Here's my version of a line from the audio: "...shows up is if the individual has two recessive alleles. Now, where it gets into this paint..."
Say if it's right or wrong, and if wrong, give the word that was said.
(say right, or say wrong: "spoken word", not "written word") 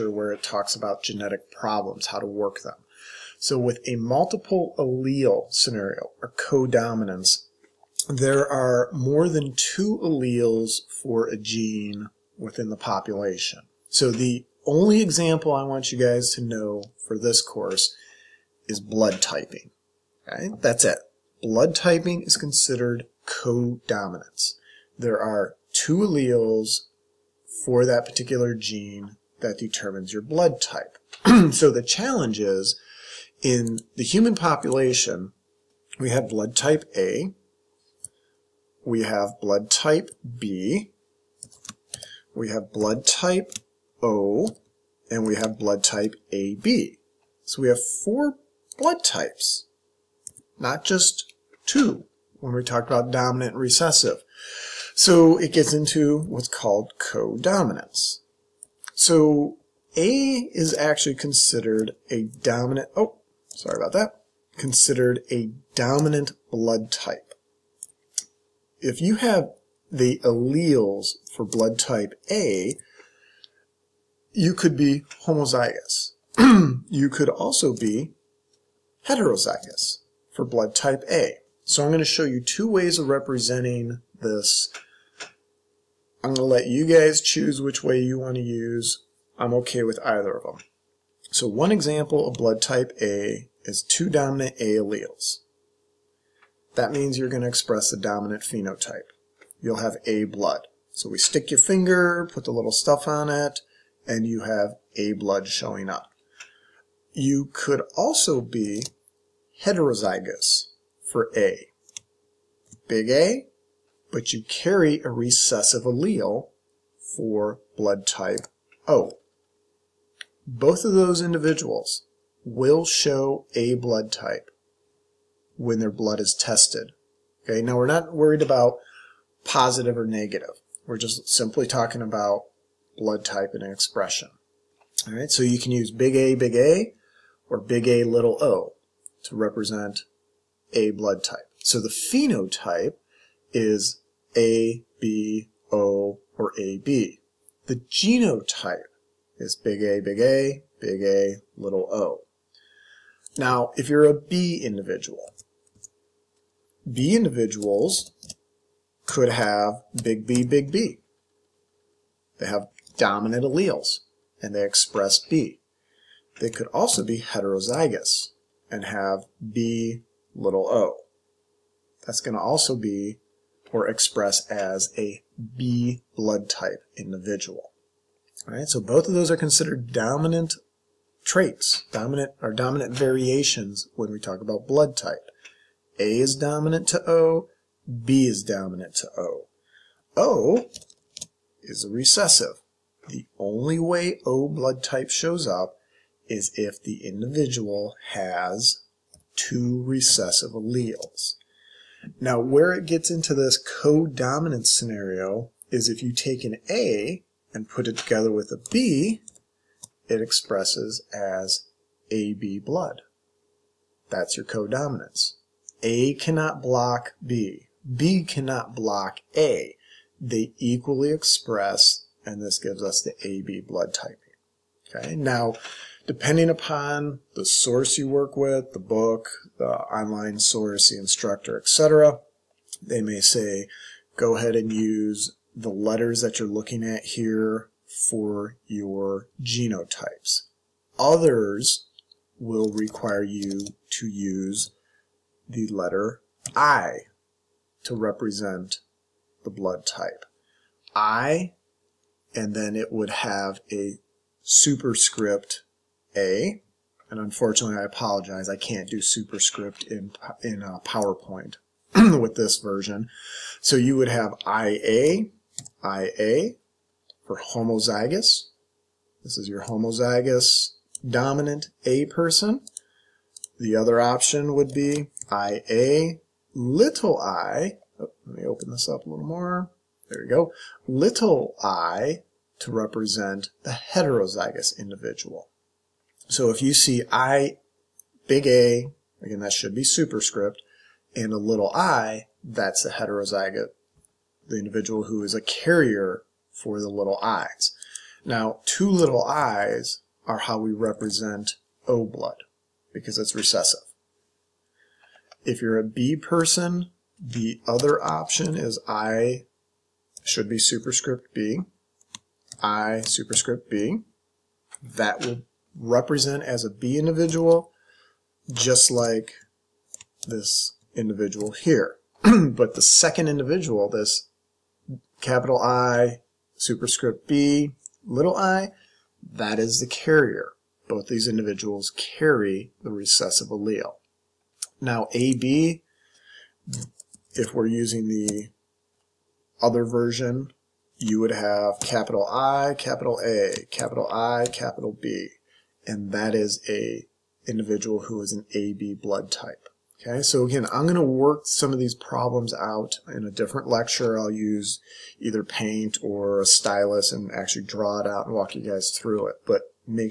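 wrong: "codominant", not "paint".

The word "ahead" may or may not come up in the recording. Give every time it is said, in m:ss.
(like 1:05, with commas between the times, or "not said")
3:54.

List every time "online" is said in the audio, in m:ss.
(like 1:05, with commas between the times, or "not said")
3:49.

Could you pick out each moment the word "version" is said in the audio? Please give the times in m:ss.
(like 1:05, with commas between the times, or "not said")
4:22, 5:39.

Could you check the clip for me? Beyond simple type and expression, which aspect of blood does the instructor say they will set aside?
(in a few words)
Positive or negative.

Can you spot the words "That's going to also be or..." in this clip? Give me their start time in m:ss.
2:52.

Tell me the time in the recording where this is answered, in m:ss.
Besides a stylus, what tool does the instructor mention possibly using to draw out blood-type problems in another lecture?
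5:55.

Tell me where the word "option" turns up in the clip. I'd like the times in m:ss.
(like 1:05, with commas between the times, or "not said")
4:33, 5:08.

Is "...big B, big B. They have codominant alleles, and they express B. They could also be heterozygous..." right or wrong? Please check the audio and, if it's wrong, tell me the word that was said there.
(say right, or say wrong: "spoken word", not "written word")
wrong: "dominant", not "codominant".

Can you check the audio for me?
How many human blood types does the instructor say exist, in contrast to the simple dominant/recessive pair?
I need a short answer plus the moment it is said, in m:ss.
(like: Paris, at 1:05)
4, at 0:48.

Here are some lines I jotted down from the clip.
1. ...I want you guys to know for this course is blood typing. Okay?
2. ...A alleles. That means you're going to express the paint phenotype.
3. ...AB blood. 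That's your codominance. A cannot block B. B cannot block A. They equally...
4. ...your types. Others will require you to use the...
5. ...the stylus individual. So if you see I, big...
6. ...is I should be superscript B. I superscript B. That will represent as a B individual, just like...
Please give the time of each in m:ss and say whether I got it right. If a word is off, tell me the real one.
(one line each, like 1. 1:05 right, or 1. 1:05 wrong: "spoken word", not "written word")
1. 0:15 right
2. 1:34 wrong: "dominant", not "paint"
3. 3:32 right
4. 3:58 wrong: "genotypes", not "types"
5. 4:43 wrong: "heterozygous", not "stylus"
6. 5:08 right.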